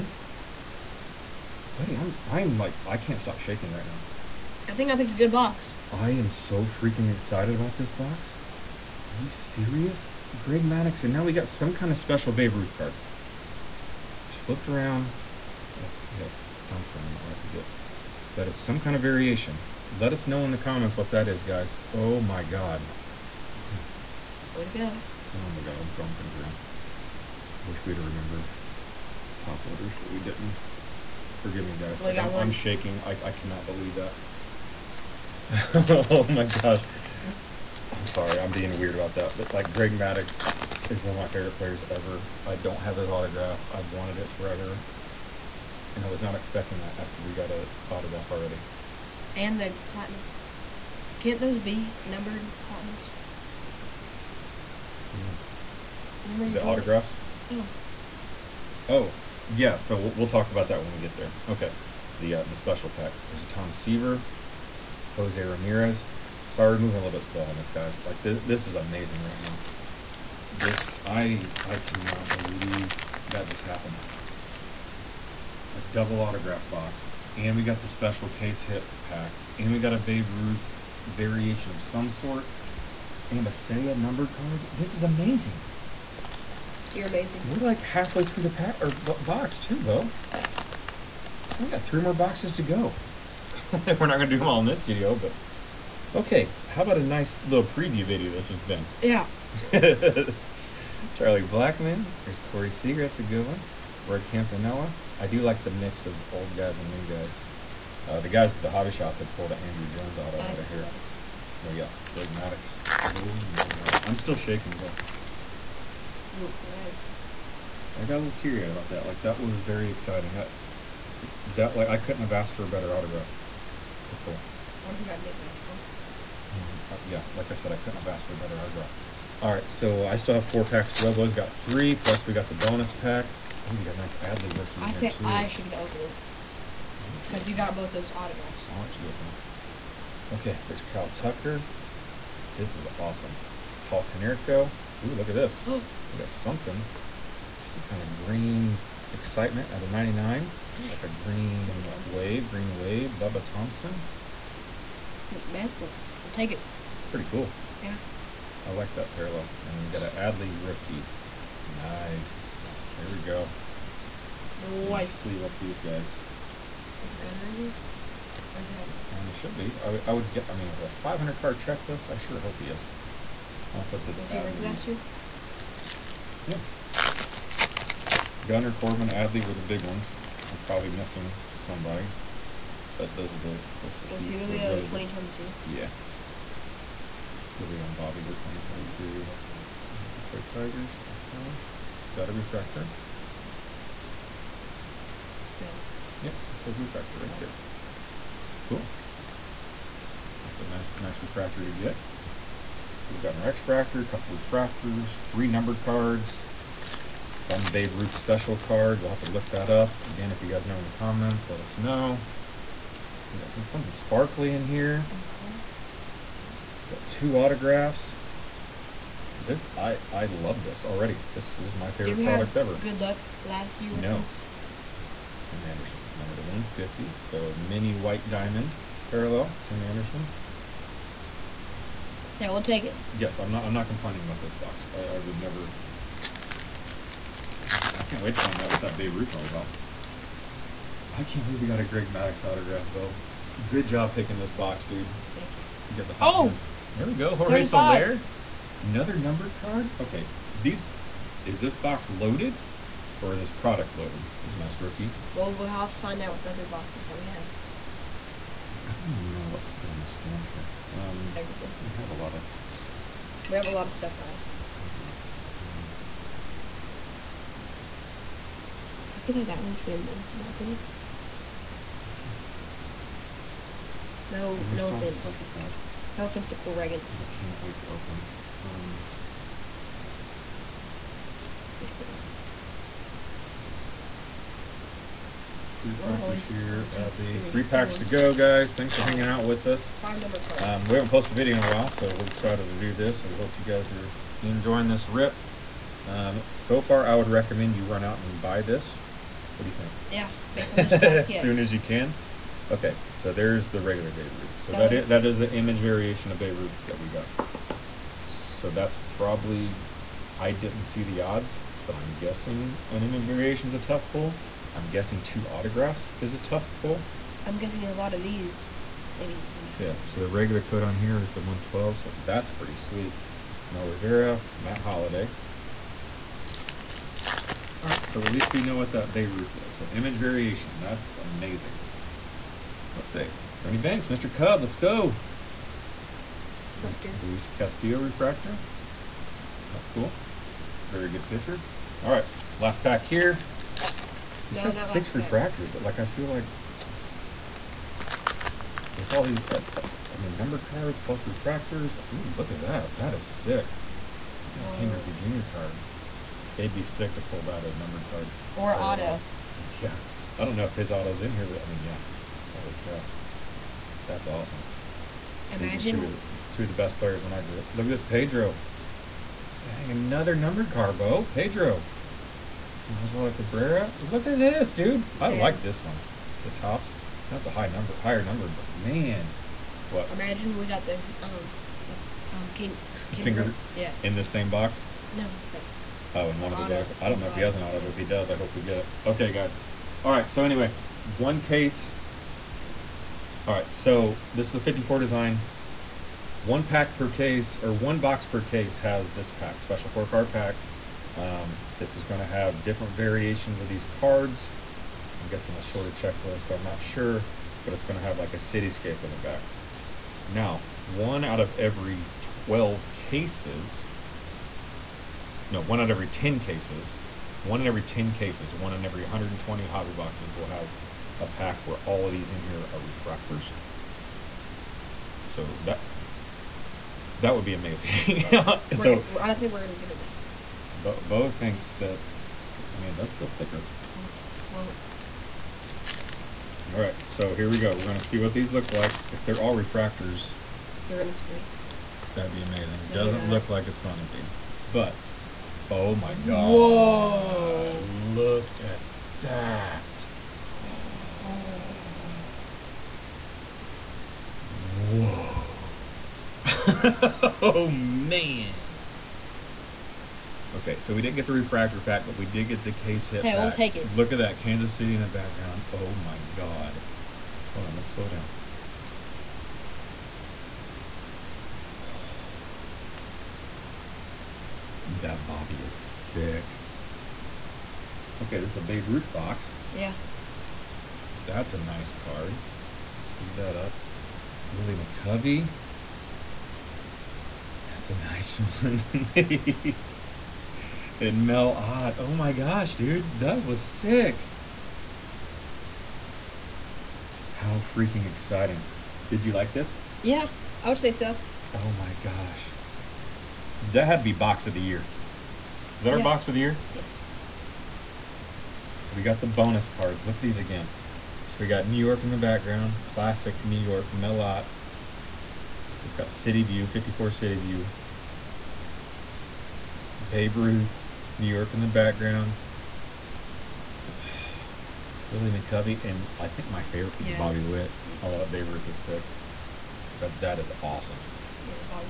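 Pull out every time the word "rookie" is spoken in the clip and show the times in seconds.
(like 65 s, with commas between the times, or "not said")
134 s, 160 s, 174 s, 254 s.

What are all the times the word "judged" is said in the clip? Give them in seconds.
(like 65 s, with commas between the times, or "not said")
not said.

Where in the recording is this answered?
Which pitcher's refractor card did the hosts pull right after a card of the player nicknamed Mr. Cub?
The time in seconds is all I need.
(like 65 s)
337 s.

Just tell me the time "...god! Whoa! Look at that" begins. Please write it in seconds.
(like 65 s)
446 s.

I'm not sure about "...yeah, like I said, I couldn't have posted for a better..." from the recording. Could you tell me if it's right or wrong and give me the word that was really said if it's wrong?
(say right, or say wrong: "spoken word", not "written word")
wrong: "asked", not "posted".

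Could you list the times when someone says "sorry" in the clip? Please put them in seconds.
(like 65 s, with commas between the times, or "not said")
38 s, 66 s.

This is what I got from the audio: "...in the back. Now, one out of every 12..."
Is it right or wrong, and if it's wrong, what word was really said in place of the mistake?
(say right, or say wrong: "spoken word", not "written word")
right.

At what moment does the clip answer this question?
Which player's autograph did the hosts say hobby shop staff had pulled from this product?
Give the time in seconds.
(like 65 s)
109 s.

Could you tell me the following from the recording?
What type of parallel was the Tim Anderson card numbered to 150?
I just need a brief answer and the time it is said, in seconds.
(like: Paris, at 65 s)
Mini white diamond, at 227 s.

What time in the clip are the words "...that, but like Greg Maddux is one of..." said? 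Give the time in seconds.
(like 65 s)
39 s.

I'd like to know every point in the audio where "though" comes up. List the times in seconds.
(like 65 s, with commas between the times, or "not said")
114 s, 242 s, 429 s.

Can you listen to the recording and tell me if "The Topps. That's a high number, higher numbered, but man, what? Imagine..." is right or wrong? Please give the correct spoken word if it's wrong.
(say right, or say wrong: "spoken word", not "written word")
right.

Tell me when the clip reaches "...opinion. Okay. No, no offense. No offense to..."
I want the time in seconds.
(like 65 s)
270 s.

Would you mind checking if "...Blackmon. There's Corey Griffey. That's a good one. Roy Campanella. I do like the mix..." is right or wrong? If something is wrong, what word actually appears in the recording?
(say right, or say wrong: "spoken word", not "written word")
wrong: "Seager", not "Griffey".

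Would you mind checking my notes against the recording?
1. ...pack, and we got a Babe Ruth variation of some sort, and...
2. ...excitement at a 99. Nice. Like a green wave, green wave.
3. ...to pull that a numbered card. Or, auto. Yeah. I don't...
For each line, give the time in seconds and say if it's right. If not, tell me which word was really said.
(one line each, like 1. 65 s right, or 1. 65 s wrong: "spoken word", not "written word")
1. 79 s right
2. 149 s right
3. 357 s right.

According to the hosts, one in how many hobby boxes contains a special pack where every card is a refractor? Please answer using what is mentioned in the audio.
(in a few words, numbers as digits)
120.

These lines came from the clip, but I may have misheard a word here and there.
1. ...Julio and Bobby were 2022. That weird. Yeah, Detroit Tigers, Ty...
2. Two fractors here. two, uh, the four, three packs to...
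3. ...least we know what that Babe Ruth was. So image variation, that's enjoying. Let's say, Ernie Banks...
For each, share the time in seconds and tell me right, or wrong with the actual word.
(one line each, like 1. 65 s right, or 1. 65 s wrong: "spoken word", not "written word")
1. 187 s right
2. 285 s wrong: "three", not "four"
3. 328 s wrong: "amazing", not "enjoying".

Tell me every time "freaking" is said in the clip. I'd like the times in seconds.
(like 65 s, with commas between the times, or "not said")
6 s, 497 s.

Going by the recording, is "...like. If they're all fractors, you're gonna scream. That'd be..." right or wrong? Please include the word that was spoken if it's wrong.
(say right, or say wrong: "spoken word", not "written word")
wrong: "refractors", not "fractors".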